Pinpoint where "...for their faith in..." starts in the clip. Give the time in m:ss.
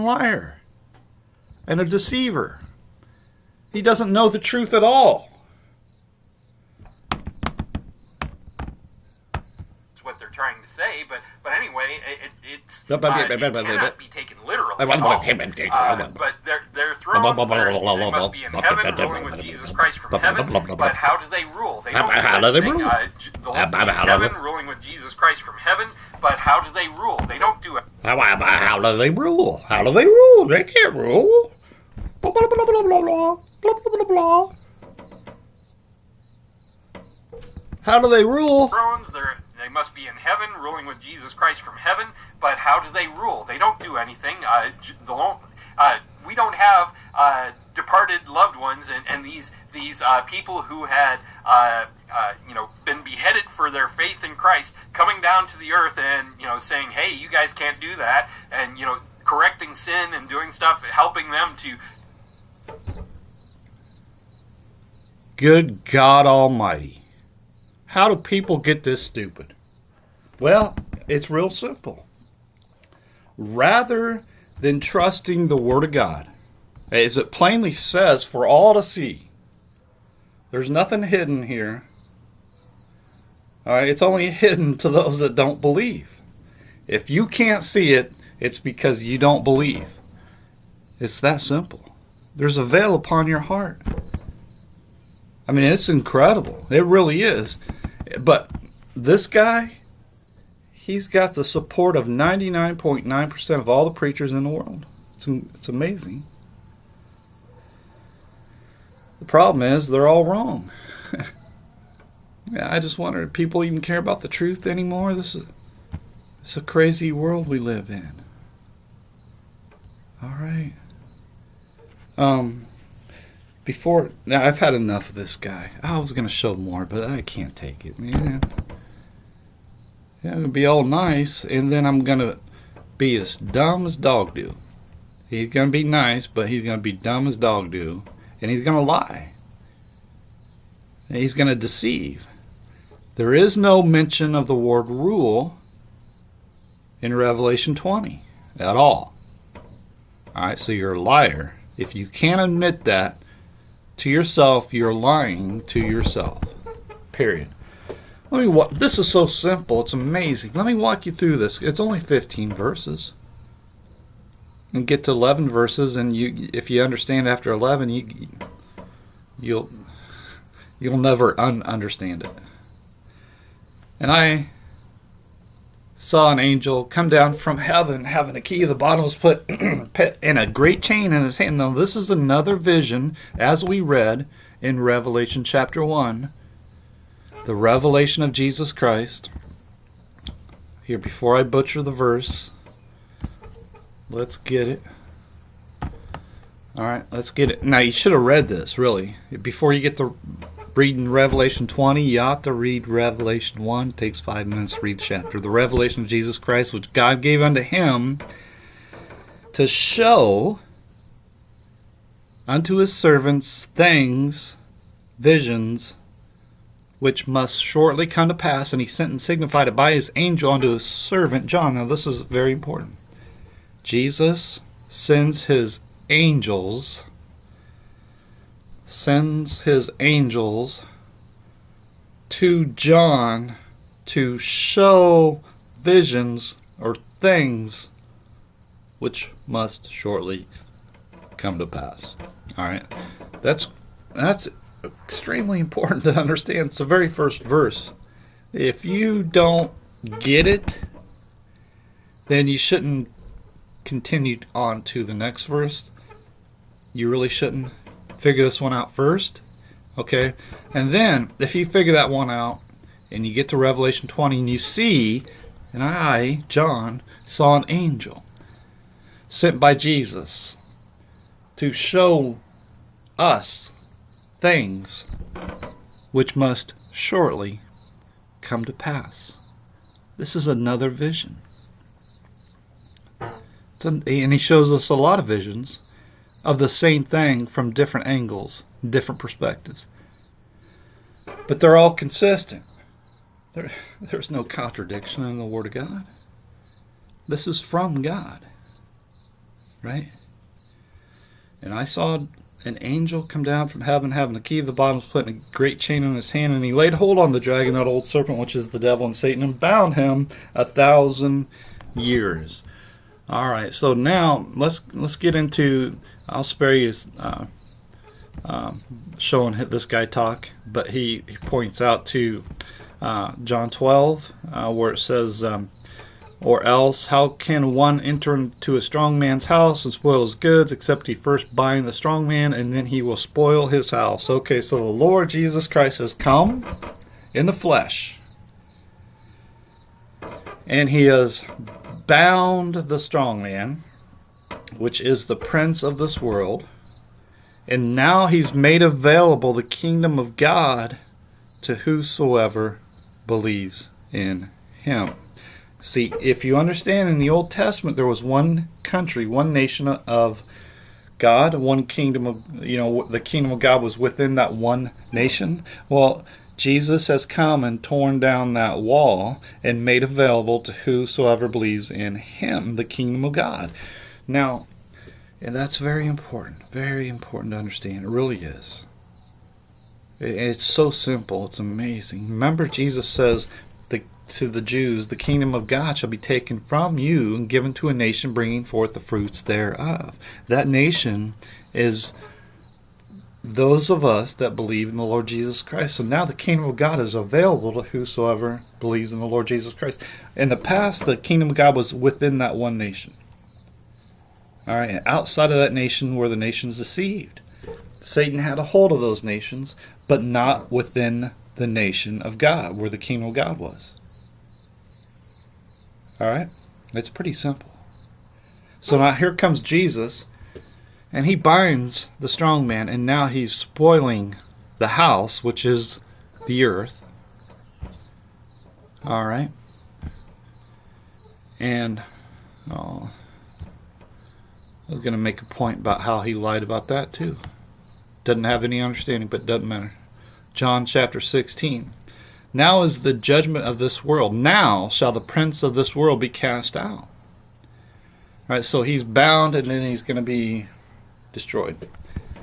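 0:53.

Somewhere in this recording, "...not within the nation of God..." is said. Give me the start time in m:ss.
6:50.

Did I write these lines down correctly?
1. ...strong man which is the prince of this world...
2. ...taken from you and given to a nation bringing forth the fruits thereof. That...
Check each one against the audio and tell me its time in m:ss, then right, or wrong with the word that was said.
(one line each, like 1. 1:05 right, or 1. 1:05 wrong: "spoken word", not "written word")
1. 5:42 right
2. 6:26 right.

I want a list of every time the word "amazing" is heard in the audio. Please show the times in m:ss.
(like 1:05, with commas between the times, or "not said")
1:45, 2:39, 6:21.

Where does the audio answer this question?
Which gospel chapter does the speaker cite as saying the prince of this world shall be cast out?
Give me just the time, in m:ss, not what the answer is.
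7:20.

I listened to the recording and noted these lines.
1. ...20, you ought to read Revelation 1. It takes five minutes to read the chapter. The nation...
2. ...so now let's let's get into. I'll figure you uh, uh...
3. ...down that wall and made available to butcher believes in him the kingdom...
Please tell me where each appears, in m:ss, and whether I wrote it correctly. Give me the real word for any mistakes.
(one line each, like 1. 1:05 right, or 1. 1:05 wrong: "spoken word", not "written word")
1. 3:21 wrong: "revelation", not "nation"
2. 5:13 wrong: "spare", not "figure"
3. 6:08 wrong: "whosoever", not "butcher".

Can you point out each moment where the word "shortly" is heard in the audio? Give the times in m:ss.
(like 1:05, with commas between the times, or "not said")
3:37, 3:59, 4:36.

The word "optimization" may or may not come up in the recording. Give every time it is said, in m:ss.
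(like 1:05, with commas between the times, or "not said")
not said.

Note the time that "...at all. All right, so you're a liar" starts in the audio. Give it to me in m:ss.
2:28.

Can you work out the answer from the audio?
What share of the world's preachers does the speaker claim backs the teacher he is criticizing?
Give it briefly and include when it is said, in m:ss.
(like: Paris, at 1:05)
99.9%, at 1:42.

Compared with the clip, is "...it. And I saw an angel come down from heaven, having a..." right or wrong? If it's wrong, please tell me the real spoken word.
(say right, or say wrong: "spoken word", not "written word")
right.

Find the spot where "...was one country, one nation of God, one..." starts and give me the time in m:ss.
5:58.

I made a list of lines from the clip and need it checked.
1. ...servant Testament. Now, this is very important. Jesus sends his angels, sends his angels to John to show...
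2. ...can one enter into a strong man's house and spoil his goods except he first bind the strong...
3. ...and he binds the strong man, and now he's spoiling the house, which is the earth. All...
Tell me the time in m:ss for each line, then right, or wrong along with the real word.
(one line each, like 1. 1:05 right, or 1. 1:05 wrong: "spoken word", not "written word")
1. 3:40 wrong: "John", not "Testament"
2. 5:27 right
3. 7:01 right.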